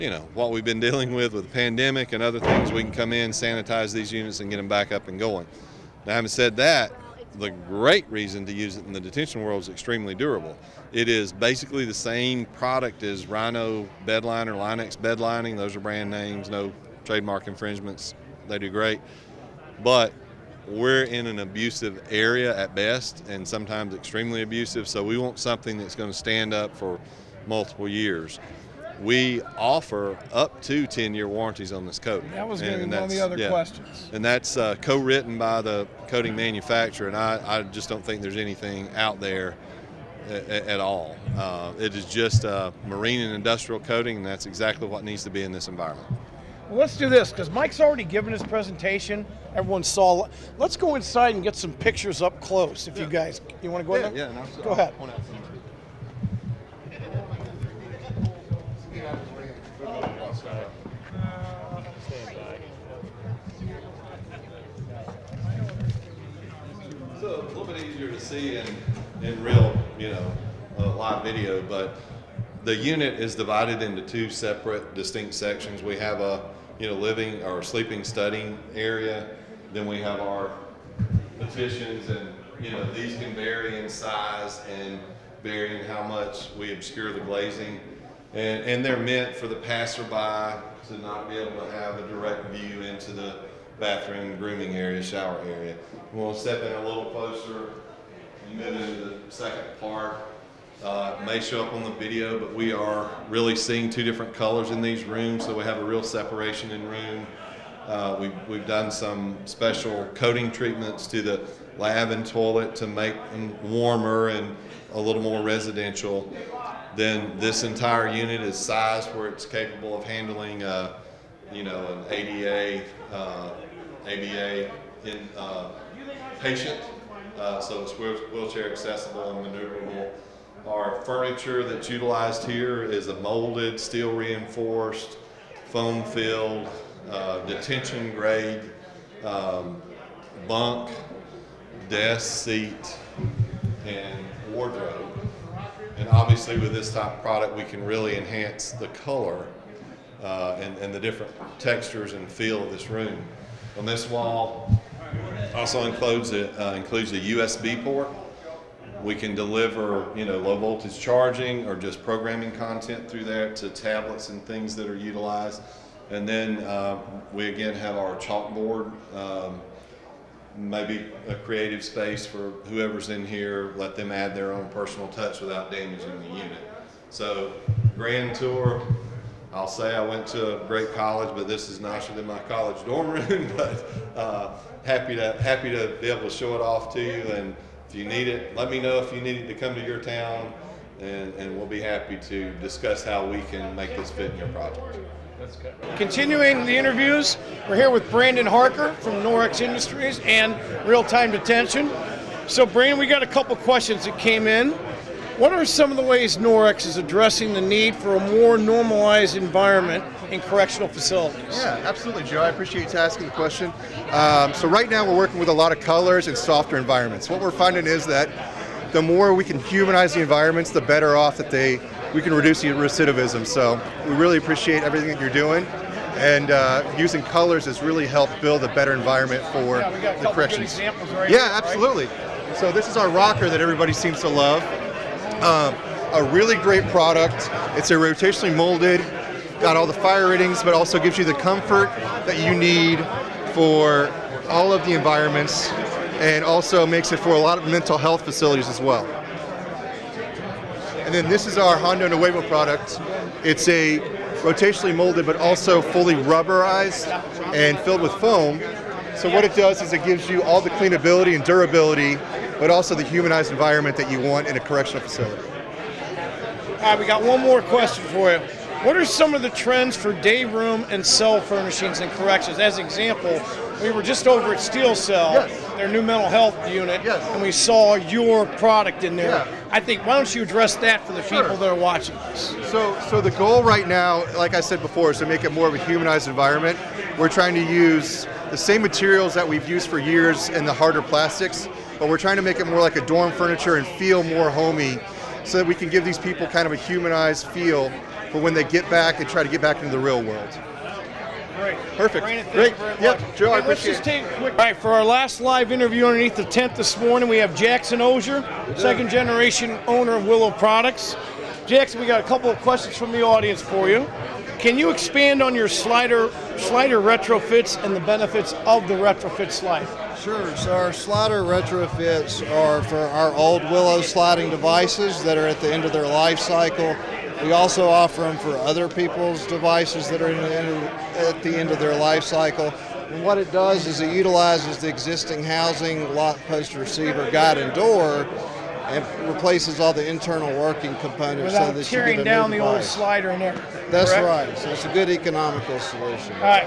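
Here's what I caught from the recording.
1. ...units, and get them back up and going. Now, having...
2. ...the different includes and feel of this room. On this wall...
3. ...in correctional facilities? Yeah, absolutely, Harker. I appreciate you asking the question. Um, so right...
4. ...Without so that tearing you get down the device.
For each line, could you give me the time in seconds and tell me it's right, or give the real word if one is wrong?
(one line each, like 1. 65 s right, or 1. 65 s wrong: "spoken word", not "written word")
1. 4 s right
2. 150 s wrong: "textures", not "includes"
3. 210 s wrong: "Joe", not "Harker"
4. 341 s right.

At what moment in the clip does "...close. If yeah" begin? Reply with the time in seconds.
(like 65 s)
52 s.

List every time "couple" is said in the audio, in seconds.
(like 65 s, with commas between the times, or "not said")
203 s, 312 s.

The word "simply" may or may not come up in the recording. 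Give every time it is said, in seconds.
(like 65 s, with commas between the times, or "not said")
not said.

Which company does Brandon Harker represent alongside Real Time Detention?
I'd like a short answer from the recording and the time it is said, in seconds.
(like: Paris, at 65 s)
Norix Industries, at 199 s.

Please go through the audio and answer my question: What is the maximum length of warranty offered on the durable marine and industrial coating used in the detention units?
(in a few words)
10 years.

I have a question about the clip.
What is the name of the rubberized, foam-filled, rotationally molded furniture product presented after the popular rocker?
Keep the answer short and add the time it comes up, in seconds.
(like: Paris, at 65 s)
Honda Nuevo, at 251 s.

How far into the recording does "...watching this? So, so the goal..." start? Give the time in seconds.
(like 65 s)
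281 s.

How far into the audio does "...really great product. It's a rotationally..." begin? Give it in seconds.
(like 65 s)
236 s.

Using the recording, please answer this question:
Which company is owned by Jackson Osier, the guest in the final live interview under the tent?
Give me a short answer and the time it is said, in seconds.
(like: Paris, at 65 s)
Willo Products, at 310 s.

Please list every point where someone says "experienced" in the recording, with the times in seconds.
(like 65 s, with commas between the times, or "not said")
not said.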